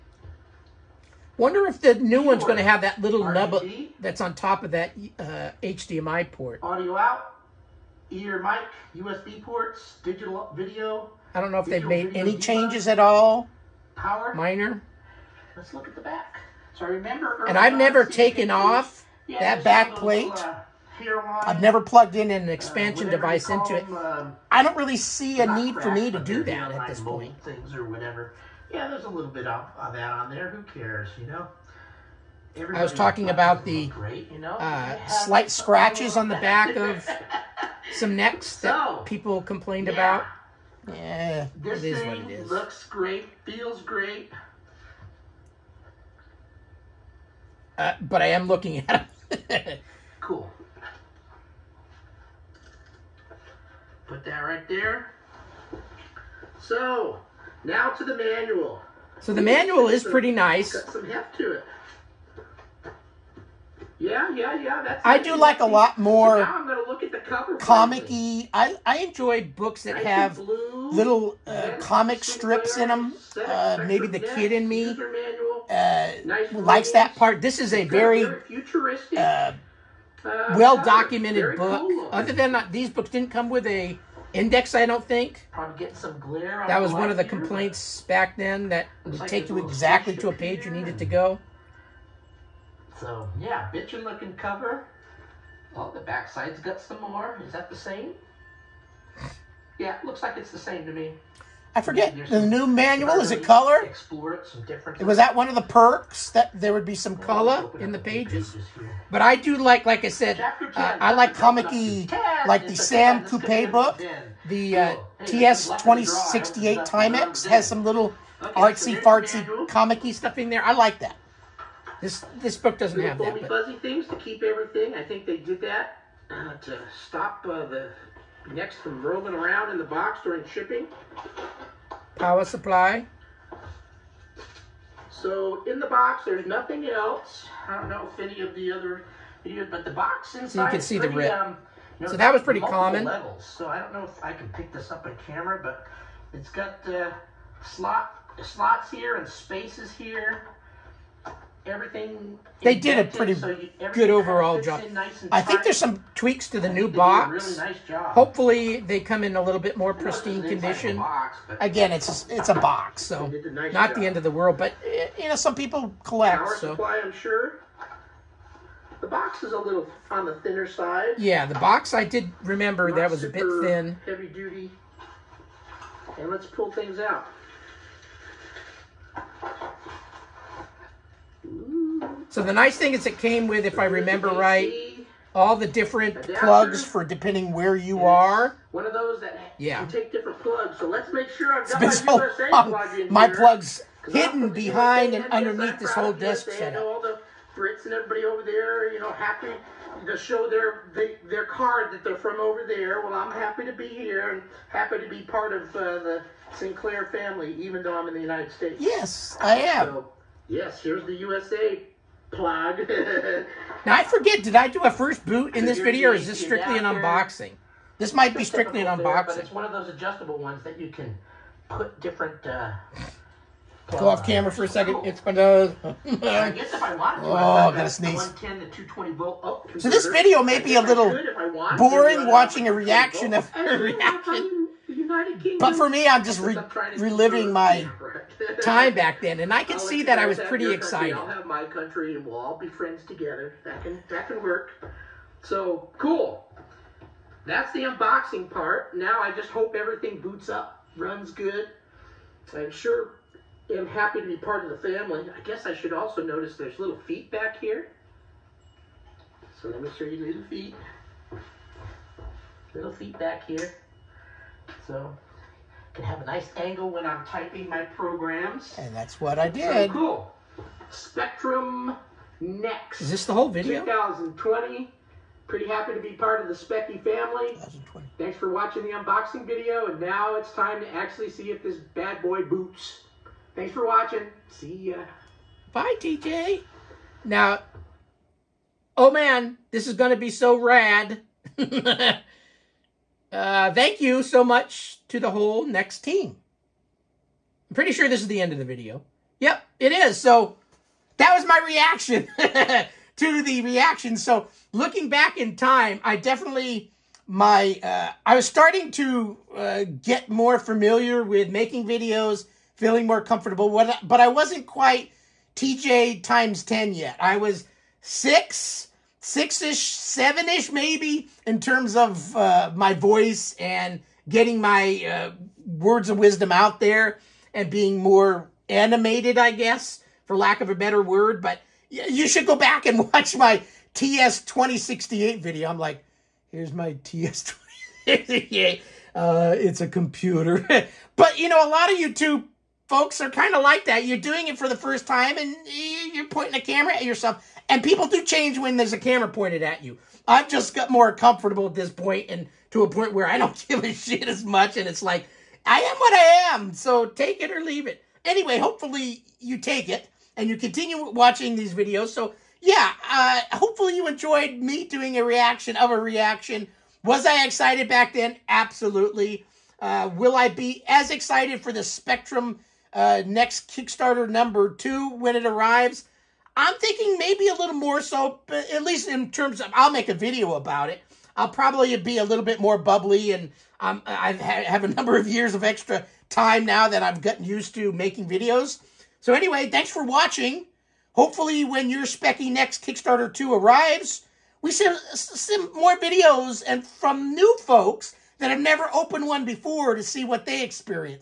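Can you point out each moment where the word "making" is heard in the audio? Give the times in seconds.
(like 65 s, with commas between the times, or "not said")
311 s, 387 s.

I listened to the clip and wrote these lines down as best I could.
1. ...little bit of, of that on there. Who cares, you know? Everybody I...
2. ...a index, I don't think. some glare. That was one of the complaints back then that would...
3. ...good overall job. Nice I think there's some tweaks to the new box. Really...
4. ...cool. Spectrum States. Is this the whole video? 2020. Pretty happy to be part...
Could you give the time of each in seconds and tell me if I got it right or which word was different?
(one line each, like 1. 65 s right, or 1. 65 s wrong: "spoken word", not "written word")
1. 29 s right
2. 83 s right
3. 153 s right
4. 269 s wrong: "Next", not "States".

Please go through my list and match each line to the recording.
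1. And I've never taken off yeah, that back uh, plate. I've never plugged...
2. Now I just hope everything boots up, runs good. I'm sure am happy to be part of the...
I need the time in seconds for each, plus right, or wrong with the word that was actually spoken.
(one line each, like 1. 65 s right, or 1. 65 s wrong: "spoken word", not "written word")
1. 17 s right
2. 248 s right.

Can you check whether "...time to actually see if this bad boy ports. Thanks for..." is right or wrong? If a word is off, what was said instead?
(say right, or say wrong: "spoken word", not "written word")
wrong: "boots", not "ports".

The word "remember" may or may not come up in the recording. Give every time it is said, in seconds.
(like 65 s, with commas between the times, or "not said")
16 s, 172 s, 183 s.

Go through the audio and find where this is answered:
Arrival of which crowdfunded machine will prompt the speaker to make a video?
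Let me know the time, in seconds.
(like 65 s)
371 s.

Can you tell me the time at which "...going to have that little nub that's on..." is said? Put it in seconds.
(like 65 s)
2 s.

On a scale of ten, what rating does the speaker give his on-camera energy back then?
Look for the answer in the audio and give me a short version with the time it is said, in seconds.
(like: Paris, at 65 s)
6, at 318 s.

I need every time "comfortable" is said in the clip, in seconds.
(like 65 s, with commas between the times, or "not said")
313 s, 351 s.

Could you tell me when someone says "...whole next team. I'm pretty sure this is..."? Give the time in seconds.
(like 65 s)
295 s.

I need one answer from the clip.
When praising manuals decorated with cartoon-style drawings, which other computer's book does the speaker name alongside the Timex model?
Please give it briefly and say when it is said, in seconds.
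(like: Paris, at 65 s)
Sam Coupe, at 112 s.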